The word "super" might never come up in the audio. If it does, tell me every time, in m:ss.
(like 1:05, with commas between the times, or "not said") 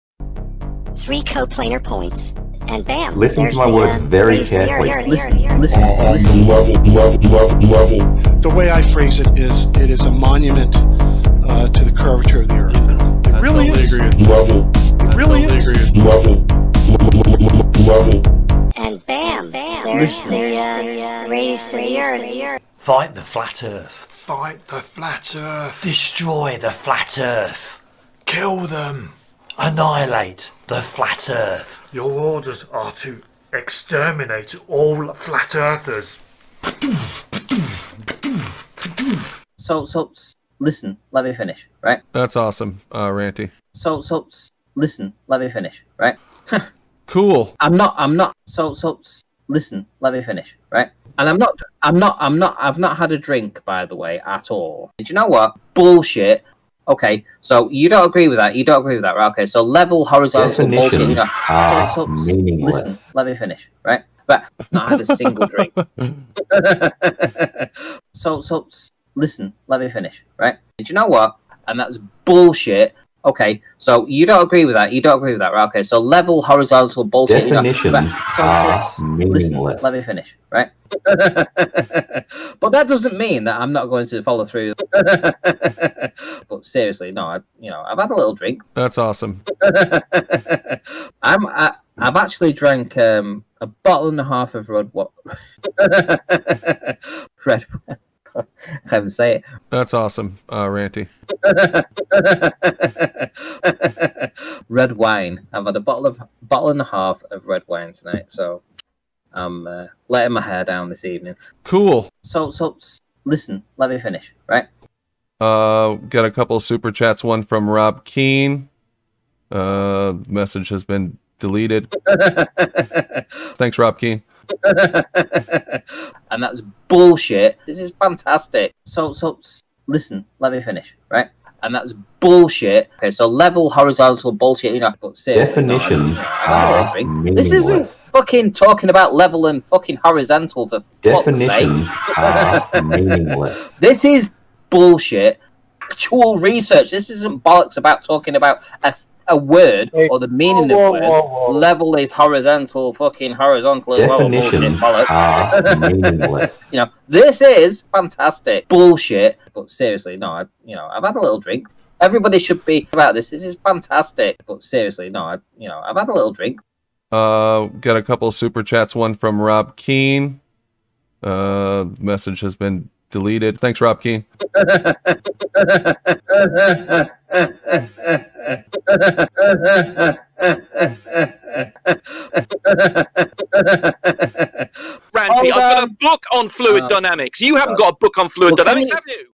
1:56, 2:48.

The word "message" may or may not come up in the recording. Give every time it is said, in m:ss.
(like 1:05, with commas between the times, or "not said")
2:00, 2:51.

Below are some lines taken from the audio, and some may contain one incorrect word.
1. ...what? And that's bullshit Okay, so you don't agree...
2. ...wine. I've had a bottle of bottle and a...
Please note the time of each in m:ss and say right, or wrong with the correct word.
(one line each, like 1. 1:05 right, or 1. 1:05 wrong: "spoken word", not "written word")
1. 1:11 right
2. 1:44 right.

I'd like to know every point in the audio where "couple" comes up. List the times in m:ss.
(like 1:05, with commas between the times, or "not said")
1:56, 2:48.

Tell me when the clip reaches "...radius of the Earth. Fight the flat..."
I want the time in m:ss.
0:21.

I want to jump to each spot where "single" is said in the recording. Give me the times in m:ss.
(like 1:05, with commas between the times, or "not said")
1:05.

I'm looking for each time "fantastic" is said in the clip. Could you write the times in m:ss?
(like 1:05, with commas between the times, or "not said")
2:07, 2:37, 2:43.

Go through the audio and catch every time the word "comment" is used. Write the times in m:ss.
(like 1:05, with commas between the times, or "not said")
not said.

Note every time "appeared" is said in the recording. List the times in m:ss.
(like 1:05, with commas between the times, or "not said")
not said.